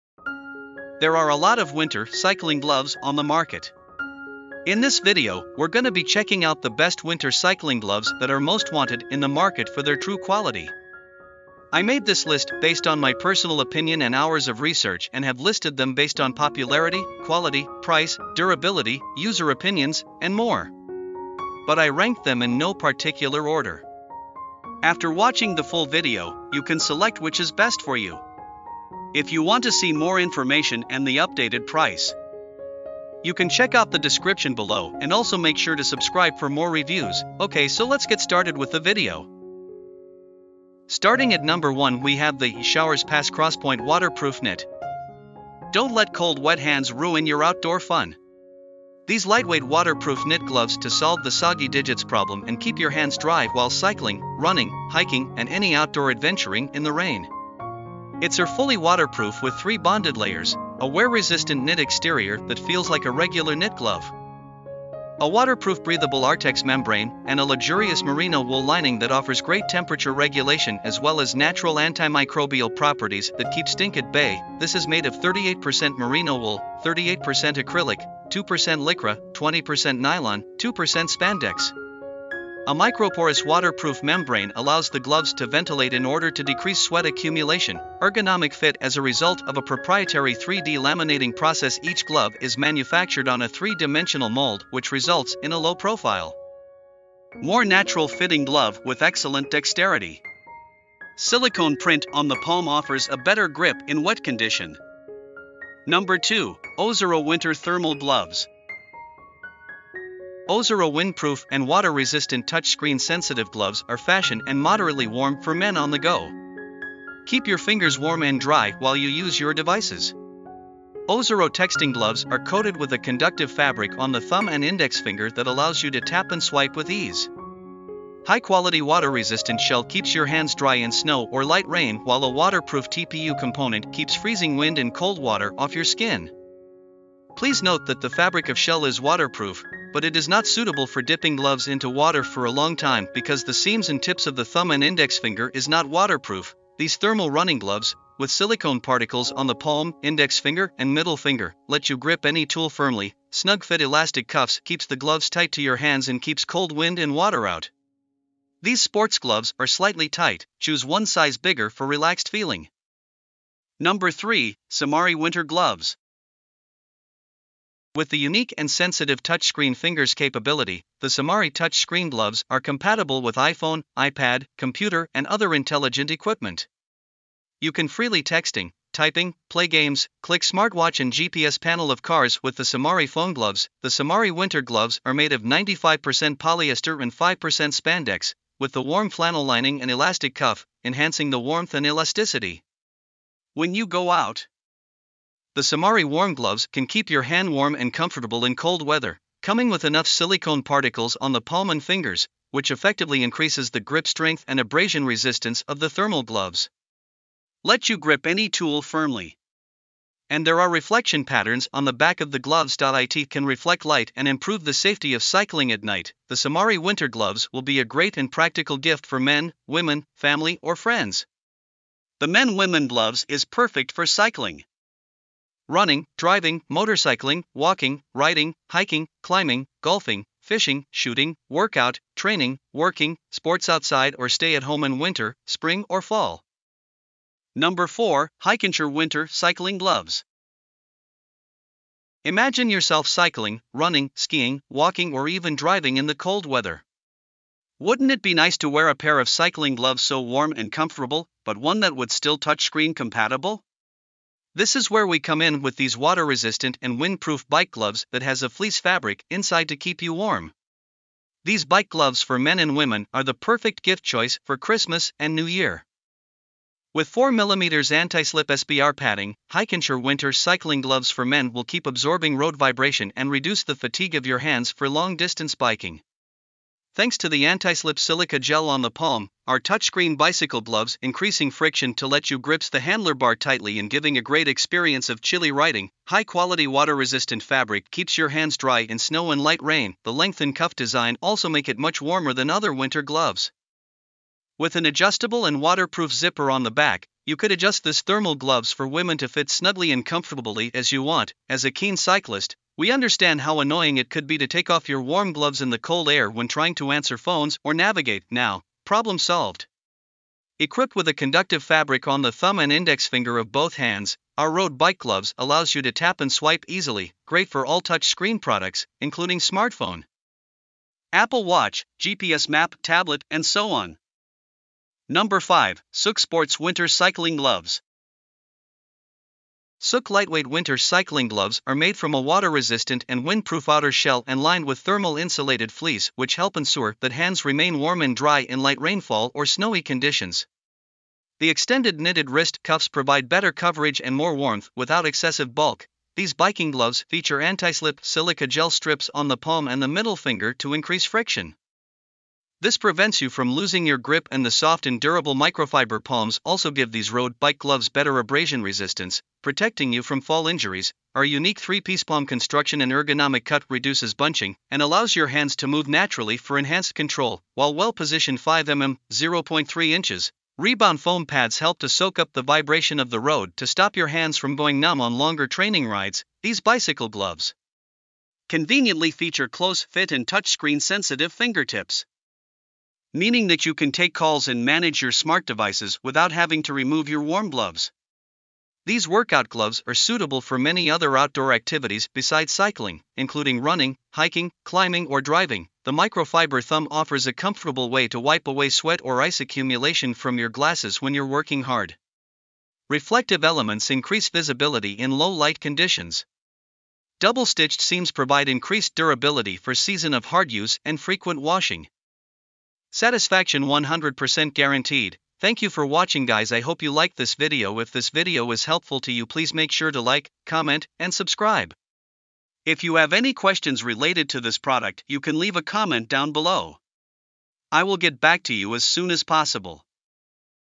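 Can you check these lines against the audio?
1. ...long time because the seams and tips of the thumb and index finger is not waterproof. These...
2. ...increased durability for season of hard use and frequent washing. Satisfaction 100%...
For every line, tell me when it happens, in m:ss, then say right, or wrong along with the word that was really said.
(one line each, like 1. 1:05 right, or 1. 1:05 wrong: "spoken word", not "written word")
1. 2:22 right
2. 6:48 right.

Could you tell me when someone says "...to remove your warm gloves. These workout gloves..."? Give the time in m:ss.
6:26.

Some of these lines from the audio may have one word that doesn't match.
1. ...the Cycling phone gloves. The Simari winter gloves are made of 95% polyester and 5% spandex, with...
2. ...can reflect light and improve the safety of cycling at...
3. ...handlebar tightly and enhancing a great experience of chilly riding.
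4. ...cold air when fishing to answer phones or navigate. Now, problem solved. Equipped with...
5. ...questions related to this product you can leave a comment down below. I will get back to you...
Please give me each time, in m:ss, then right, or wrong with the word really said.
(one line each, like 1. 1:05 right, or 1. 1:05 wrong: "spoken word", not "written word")
1. 3:02 wrong: "Simari", not "Cycling"
2. 3:33 right
3. 4:42 wrong: "giving", not "enhancing"
4. 5:05 wrong: "trying", not "fishing"
5. 7:03 right.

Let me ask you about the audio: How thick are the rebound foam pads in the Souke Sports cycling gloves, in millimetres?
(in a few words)
5 mm.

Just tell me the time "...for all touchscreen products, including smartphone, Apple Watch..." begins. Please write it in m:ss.
5:17.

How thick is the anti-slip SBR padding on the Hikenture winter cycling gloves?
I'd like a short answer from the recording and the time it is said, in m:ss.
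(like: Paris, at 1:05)
4mm, at 4:27.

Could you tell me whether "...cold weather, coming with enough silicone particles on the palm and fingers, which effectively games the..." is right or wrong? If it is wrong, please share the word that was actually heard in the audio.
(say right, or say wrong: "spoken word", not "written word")
wrong: "increases", not "games".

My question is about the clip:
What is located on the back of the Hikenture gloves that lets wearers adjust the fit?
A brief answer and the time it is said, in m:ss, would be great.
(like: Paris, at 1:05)
zipper, at 4:56.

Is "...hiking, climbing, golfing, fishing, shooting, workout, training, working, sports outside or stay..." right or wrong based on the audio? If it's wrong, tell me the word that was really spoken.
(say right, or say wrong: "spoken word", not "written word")
right.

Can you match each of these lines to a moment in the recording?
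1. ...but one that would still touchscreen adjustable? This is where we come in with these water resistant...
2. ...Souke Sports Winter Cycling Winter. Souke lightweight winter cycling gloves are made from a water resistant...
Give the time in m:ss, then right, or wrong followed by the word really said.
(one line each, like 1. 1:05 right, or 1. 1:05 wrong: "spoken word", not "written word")
1. 4:11 wrong: "compatible", not "adjustable"
2. 5:25 wrong: "Gloves", not "Winter".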